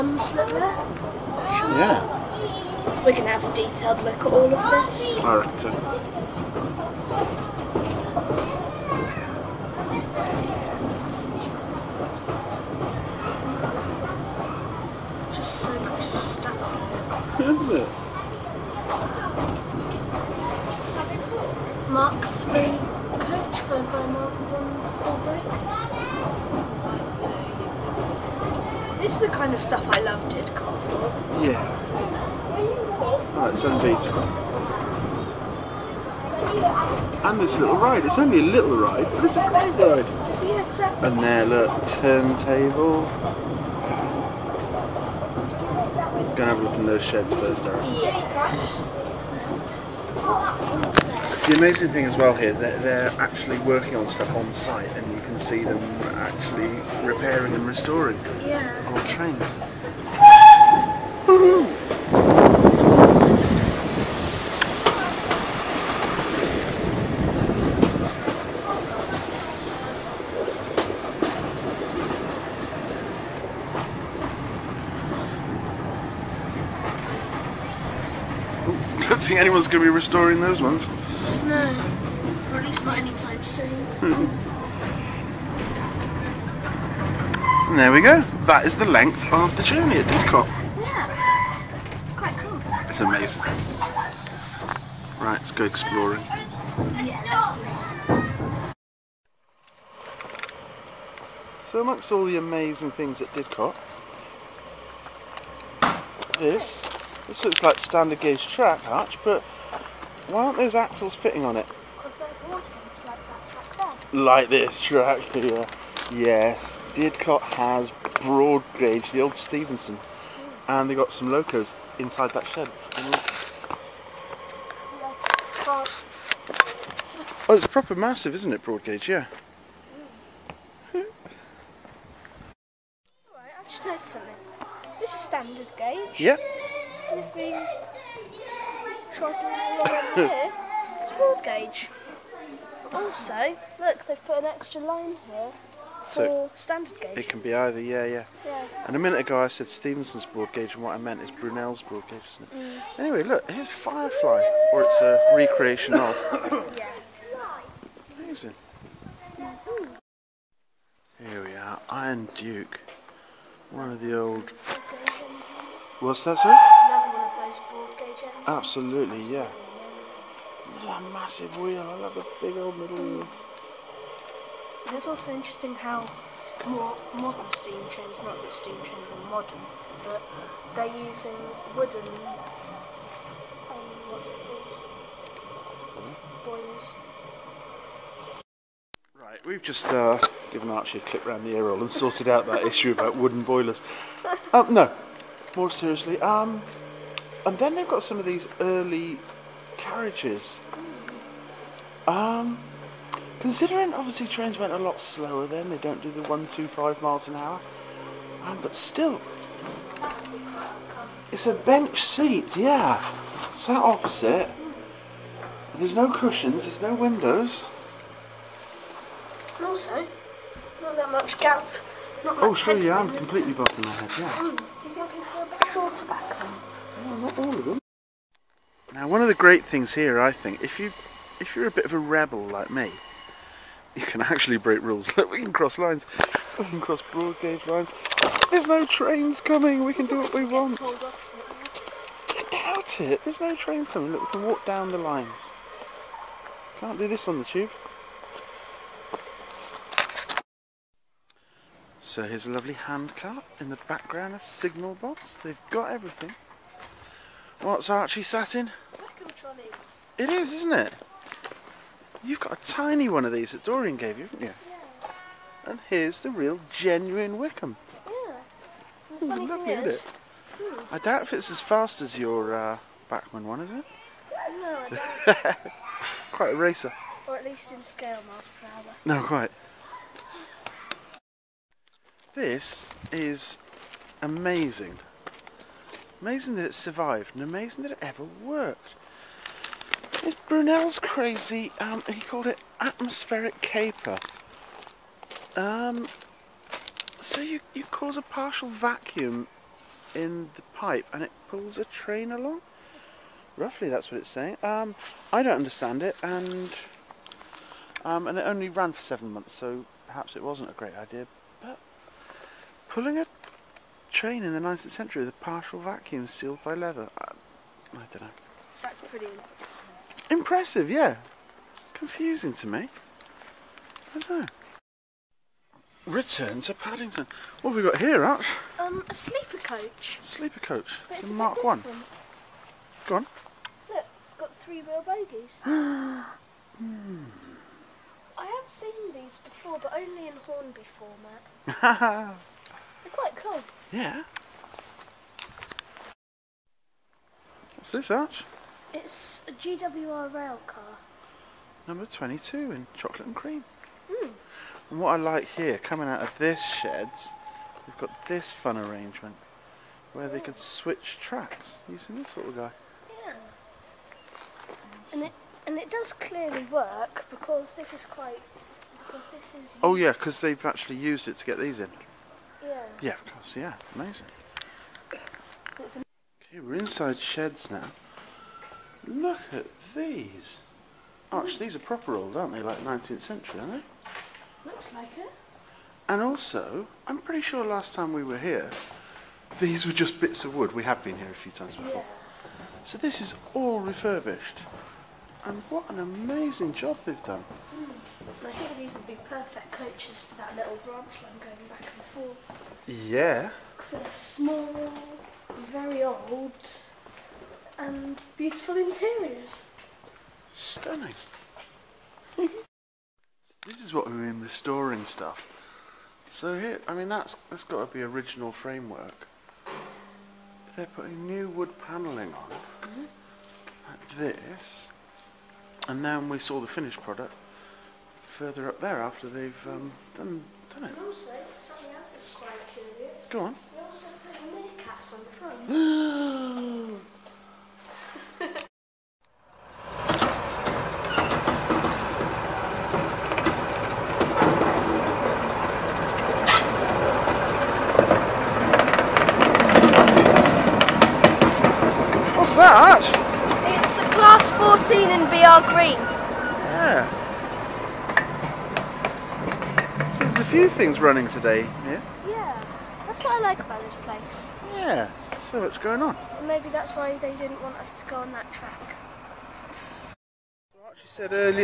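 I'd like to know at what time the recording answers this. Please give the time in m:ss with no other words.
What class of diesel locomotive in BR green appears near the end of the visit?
7:34.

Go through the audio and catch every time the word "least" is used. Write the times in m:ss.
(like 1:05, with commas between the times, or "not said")
1:22, 4:37.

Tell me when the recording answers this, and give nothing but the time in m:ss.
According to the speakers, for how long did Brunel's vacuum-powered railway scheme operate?
5:08.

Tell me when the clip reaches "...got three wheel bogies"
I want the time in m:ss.
5:34.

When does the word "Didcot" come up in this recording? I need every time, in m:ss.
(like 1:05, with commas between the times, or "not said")
1:30, 1:43, 1:56.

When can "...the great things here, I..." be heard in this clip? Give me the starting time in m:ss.
3:49.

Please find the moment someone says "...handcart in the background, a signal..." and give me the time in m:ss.
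4:12.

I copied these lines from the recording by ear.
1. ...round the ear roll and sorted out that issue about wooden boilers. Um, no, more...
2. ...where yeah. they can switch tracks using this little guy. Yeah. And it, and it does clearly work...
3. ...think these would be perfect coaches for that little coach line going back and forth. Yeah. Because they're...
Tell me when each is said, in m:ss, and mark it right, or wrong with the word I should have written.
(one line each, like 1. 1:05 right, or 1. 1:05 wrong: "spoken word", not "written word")
1. 3:11 right
2. 6:00 right
3. 6:38 wrong: "branch", not "coach".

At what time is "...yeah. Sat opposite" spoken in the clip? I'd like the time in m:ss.
3:32.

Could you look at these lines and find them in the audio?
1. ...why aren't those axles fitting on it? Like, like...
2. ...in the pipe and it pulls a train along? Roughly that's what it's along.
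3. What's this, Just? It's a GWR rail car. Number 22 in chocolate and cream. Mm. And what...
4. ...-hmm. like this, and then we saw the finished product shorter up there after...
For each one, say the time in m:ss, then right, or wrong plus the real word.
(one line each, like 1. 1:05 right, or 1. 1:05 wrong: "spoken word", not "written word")
1. 1:50 right
2. 5:00 wrong: "saying", not "along"
3. 5:47 wrong: "Arch", not "Just"
4. 7:02 wrong: "further", not "shorter".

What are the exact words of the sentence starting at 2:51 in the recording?
I love the big old middle wheel.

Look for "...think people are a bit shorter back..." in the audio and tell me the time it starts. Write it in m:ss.
3:44.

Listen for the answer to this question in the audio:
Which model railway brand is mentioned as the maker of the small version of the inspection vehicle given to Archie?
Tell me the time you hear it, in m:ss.
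4:33.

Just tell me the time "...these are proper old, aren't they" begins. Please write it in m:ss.
6:21.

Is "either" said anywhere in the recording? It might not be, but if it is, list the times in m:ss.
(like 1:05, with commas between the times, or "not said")
2:27.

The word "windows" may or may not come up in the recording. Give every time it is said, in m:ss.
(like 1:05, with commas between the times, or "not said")
3:36.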